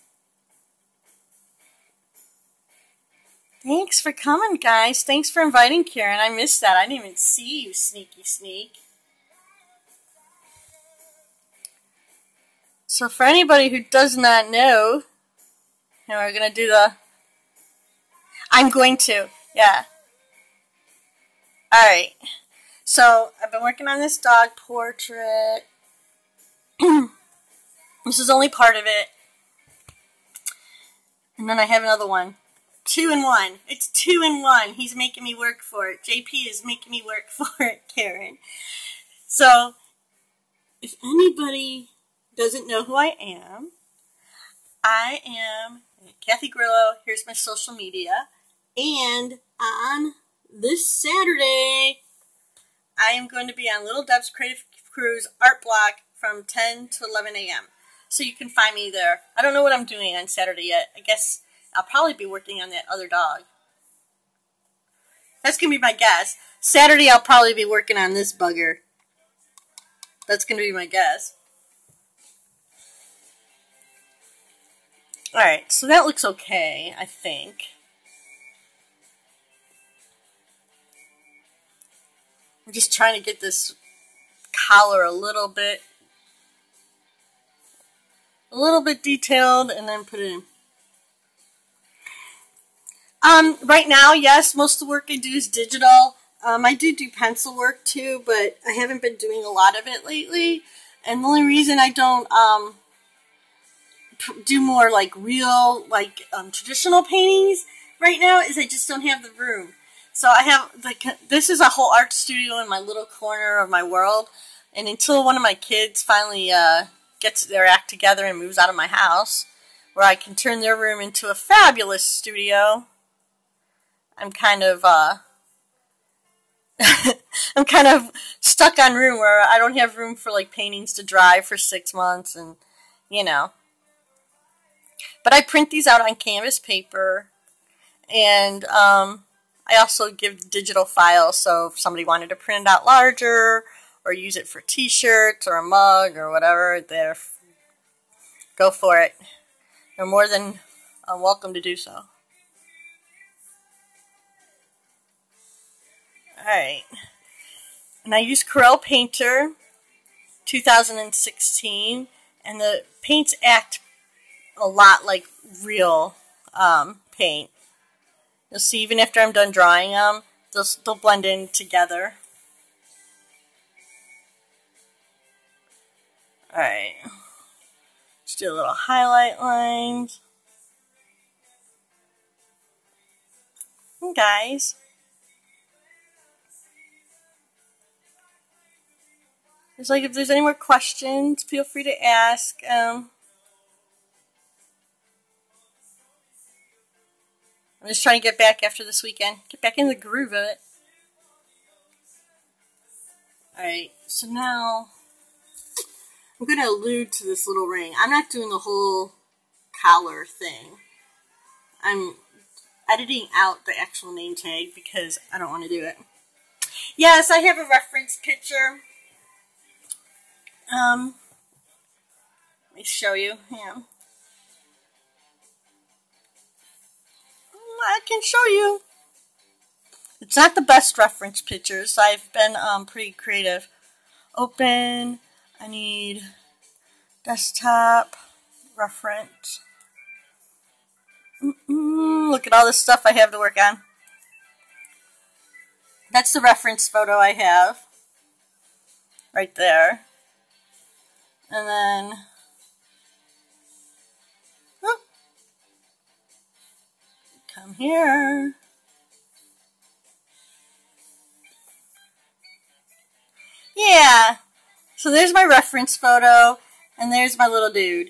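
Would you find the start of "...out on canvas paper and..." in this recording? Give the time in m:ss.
2:15.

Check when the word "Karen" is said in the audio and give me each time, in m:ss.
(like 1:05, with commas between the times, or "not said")
0:05, 0:37.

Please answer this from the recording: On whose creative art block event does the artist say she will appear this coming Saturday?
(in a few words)
Little Deb's Creative Cruise.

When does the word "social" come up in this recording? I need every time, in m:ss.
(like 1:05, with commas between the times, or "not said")
0:47.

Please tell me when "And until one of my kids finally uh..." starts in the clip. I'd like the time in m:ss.
1:54.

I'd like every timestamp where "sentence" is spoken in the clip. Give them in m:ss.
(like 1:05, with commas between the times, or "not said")
not said.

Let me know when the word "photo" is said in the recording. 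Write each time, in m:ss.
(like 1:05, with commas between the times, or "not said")
4:06, 4:25.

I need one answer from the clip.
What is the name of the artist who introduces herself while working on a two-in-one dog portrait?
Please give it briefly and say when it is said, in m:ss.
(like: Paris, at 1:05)
Kathy Grillo, at 0:46.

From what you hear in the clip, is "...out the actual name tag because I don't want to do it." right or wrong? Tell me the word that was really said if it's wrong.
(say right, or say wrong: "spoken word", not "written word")
right.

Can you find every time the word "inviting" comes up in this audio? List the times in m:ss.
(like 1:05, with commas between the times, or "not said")
0:05.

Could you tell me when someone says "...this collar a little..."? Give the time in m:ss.
1:23.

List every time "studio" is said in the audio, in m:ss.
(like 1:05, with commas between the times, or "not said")
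1:52, 2:02.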